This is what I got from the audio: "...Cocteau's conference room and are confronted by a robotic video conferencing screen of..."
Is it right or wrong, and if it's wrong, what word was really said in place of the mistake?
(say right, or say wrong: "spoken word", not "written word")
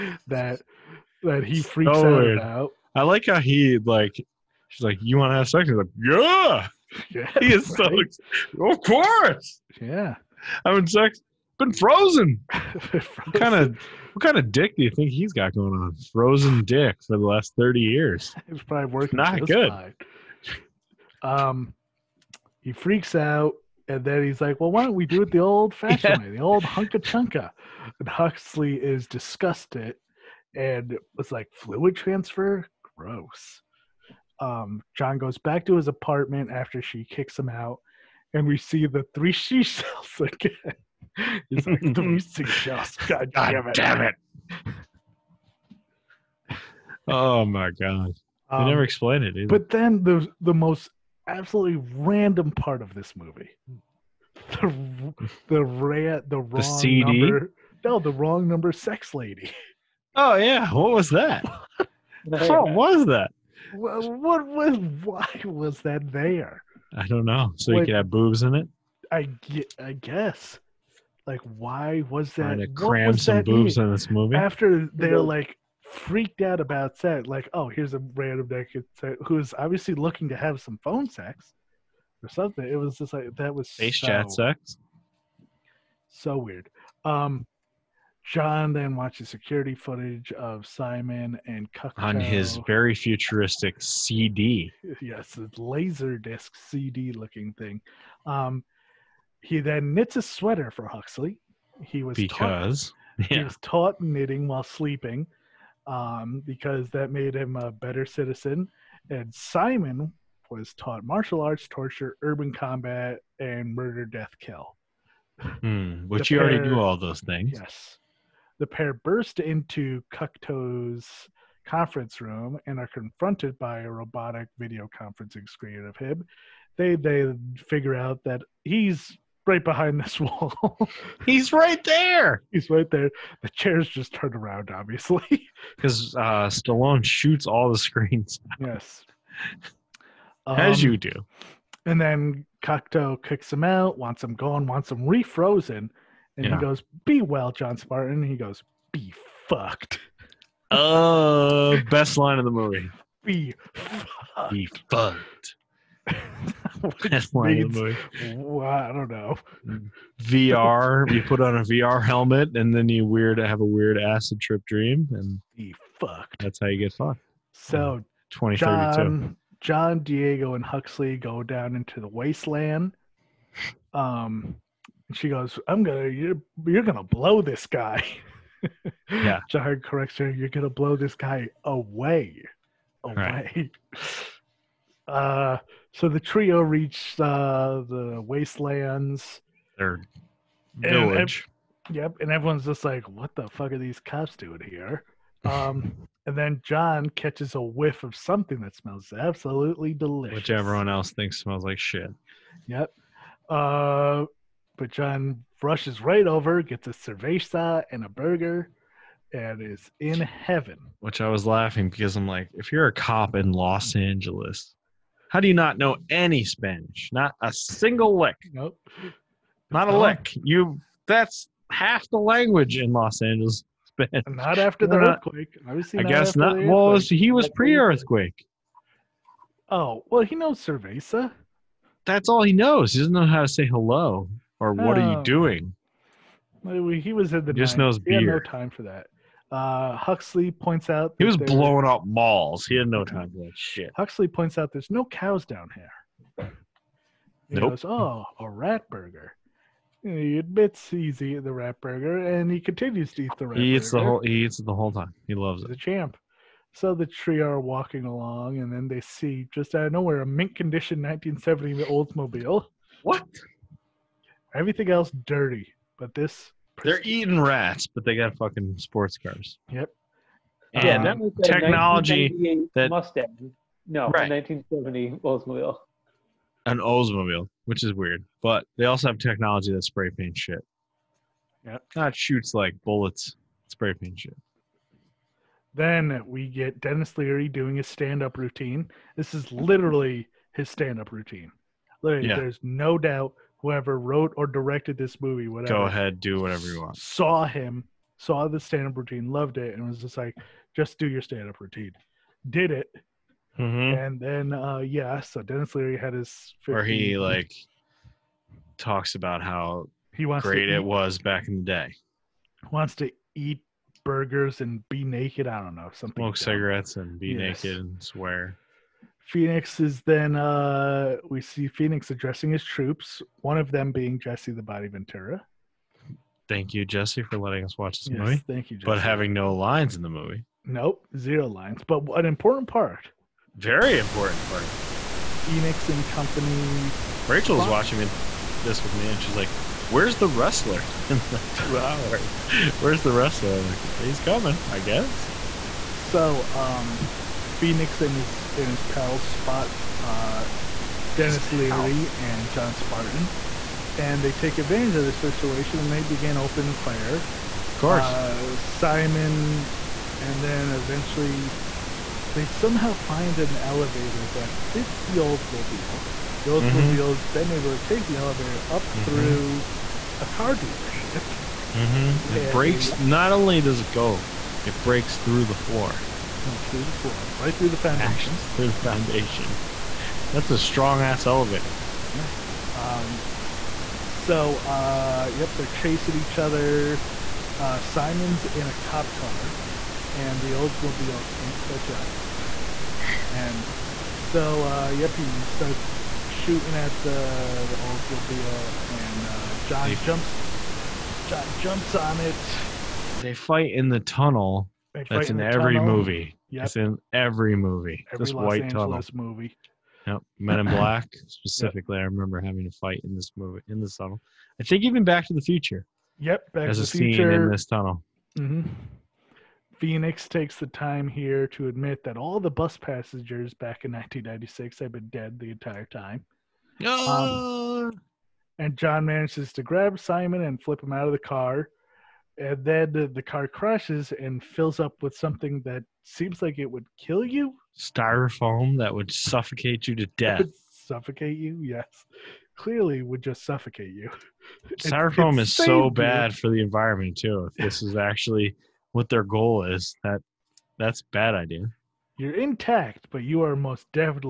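right.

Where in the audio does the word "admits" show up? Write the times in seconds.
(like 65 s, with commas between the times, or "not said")
250 s, 421 s.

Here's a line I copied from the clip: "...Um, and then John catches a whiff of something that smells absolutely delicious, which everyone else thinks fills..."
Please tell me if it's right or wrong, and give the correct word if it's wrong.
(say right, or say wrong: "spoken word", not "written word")
wrong: "smells", not "fills".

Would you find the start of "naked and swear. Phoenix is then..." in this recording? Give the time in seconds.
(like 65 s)
317 s.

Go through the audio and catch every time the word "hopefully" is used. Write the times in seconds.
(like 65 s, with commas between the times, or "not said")
not said.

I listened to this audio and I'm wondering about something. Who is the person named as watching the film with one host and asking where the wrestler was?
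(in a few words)
Rachel.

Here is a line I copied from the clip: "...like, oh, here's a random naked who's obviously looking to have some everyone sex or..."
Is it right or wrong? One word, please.
wrong.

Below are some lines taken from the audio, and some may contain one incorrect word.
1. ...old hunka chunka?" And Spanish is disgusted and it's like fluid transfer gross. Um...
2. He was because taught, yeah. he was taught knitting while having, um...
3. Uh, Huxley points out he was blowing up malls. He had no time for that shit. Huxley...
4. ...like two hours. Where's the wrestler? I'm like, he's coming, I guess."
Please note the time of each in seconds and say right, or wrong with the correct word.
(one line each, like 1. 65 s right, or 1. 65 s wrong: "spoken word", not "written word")
1. 26 s wrong: "Huxley", not "Spanish"
2. 101 s wrong: "sleeping", not "having"
3. 239 s right
4. 341 s right.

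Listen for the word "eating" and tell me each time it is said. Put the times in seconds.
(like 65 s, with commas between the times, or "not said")
251 s, 267 s.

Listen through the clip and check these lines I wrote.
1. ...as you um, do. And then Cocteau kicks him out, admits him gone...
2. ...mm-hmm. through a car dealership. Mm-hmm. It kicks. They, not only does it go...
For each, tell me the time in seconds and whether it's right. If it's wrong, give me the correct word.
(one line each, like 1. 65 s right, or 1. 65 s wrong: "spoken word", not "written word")
1. 140 s wrong: "wants", not "admits"
2. 368 s wrong: "breaks", not "kicks".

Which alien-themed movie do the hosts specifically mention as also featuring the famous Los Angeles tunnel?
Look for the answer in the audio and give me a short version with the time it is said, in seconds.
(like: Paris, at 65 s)
Men in Black, at 410 s.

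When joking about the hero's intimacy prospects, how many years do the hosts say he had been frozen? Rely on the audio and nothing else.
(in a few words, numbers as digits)
30.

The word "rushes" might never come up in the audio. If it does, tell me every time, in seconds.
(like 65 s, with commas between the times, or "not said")
205 s.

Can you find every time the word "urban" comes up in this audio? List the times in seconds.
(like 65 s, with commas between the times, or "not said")
112 s.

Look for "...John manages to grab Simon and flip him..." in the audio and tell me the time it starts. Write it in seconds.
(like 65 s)
428 s.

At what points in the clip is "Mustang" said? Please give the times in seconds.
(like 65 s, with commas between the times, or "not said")
272 s.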